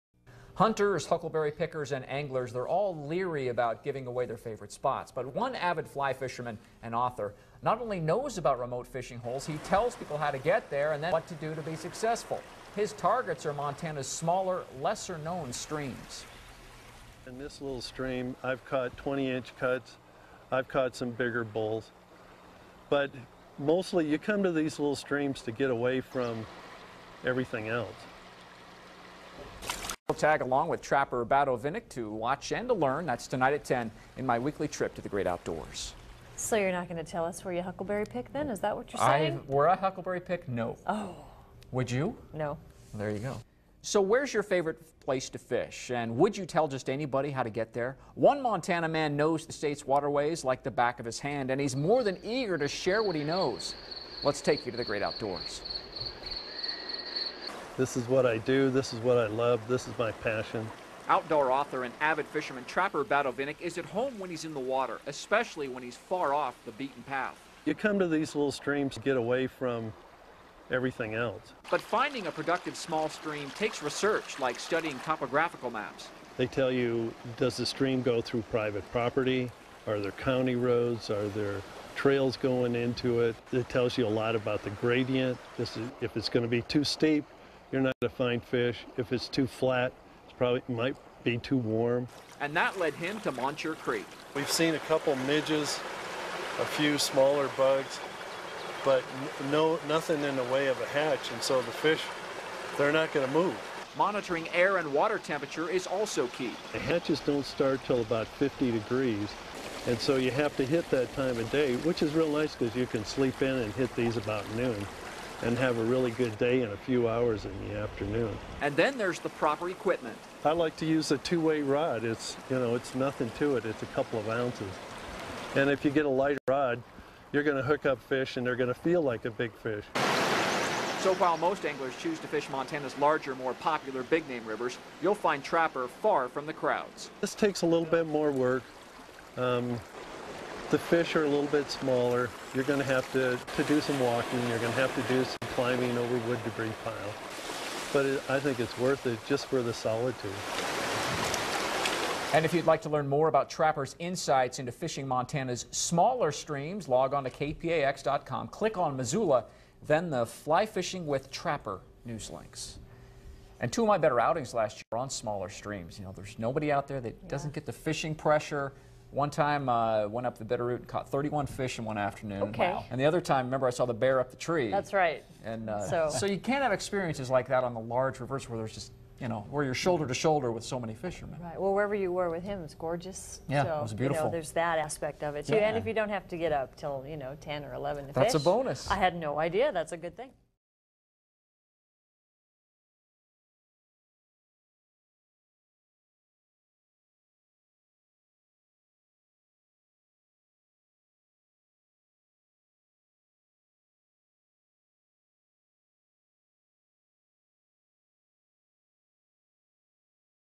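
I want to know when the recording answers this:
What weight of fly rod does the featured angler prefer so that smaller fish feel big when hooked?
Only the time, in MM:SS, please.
02:01.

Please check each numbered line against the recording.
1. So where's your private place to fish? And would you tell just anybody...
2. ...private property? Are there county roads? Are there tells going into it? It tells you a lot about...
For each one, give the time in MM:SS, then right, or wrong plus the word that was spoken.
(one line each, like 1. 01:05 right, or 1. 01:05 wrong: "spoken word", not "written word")
1. 00:43 wrong: "favorite", not "private"
2. 01:18 wrong: "trails", not "tells".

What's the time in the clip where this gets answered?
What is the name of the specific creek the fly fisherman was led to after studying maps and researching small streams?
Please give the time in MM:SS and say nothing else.
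01:33.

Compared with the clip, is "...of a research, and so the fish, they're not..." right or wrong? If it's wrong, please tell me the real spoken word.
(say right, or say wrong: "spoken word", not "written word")
wrong: "hatch", not "research".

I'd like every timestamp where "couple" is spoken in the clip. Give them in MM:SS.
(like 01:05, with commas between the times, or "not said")
01:34, 02:03.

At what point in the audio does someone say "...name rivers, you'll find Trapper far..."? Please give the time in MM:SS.
02:14.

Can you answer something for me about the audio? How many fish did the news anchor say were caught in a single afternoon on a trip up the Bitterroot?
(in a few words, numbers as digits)
31.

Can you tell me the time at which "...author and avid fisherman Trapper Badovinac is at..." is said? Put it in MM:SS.
01:01.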